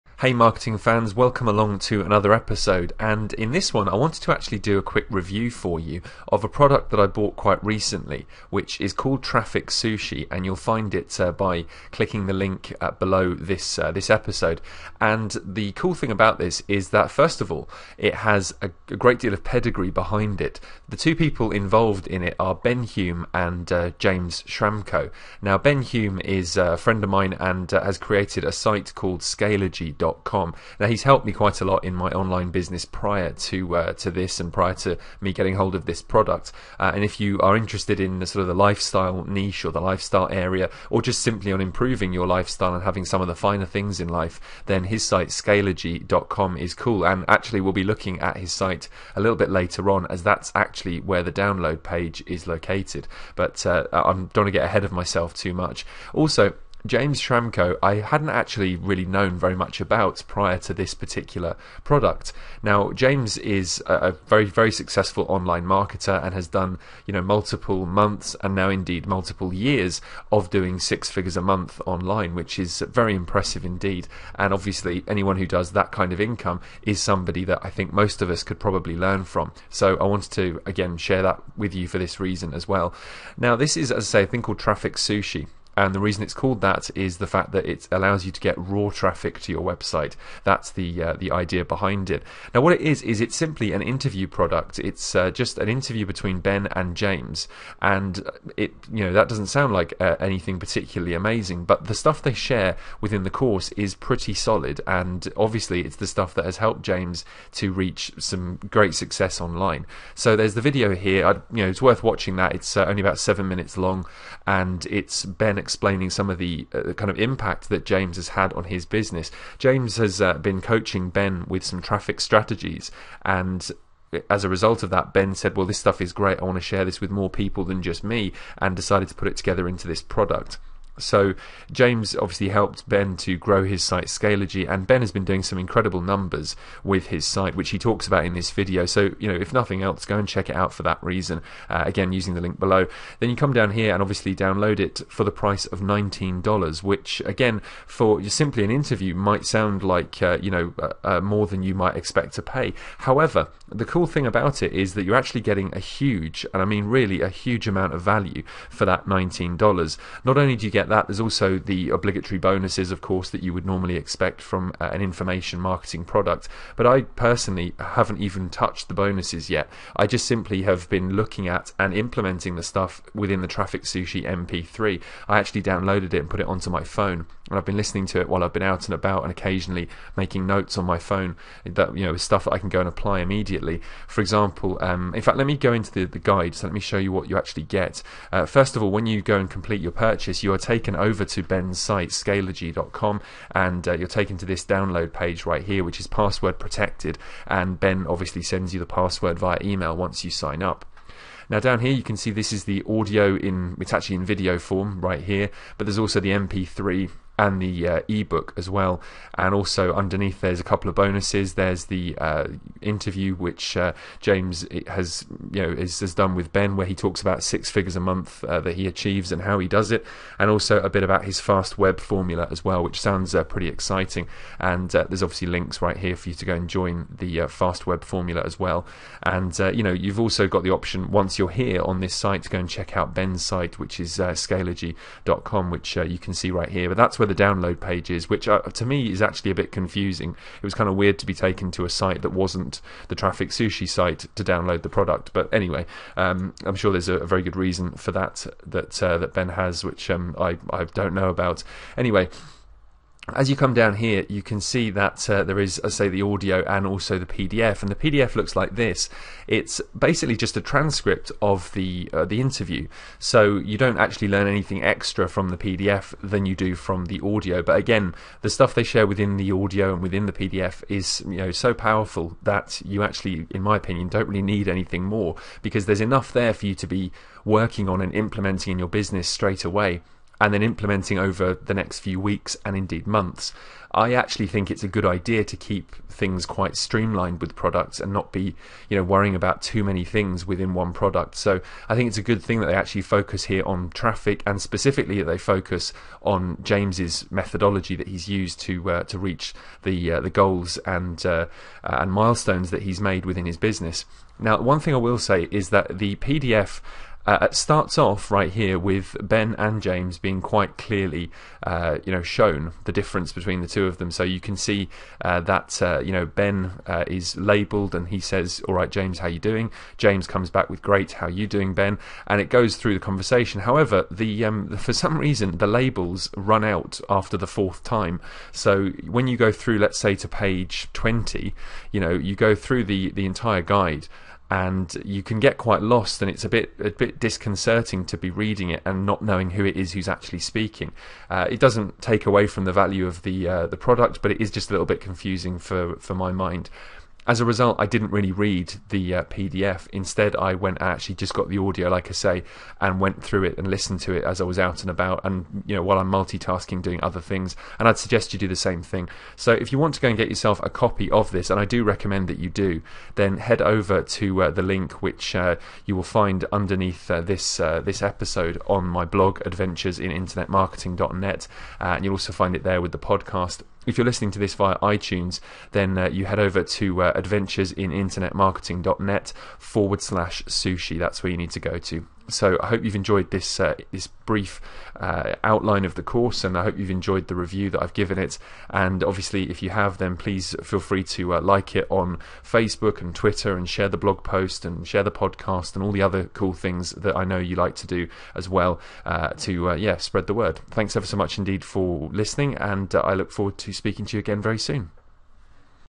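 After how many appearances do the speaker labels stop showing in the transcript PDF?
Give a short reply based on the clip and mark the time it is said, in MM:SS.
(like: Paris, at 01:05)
4, at 05:27.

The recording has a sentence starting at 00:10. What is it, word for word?
And you'll find it uh, by clicking the link uh, below this, uh, this episode.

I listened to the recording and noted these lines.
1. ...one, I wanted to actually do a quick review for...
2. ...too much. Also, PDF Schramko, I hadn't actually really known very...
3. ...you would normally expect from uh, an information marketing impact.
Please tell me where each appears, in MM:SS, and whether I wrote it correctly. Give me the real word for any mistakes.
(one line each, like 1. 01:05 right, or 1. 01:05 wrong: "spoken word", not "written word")
1. 00:03 right
2. 00:55 wrong: "James", not "PDF"
3. 02:43 wrong: "product", not "impact".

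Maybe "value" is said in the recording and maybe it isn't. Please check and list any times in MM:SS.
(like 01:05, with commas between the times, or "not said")
02:38, 05:42.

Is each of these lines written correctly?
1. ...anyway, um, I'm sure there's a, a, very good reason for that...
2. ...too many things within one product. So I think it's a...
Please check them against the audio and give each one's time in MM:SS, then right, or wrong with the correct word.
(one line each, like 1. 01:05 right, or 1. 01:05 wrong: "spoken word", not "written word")
1. 04:05 right
2. 04:49 right.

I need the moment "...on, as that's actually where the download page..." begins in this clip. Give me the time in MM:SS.
00:49.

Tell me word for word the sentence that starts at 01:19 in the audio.
So I wanted to, again, share that with you for this reason as well.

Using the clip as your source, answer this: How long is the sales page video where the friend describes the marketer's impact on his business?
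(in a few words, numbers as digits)
About 7 minutes.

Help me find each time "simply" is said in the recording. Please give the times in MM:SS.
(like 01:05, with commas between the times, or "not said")
00:41, 01:33, 02:28, 02:50.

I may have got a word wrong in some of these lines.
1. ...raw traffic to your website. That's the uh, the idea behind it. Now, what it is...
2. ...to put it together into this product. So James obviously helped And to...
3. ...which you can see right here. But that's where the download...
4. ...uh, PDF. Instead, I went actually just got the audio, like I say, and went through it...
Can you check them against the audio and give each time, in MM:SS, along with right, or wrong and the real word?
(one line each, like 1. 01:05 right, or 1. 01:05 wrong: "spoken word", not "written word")
1. 01:28 right
2. 02:09 wrong: "Ben", not "And"
3. 03:55 right
4. 05:49 right.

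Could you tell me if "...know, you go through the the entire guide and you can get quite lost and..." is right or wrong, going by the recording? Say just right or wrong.
right.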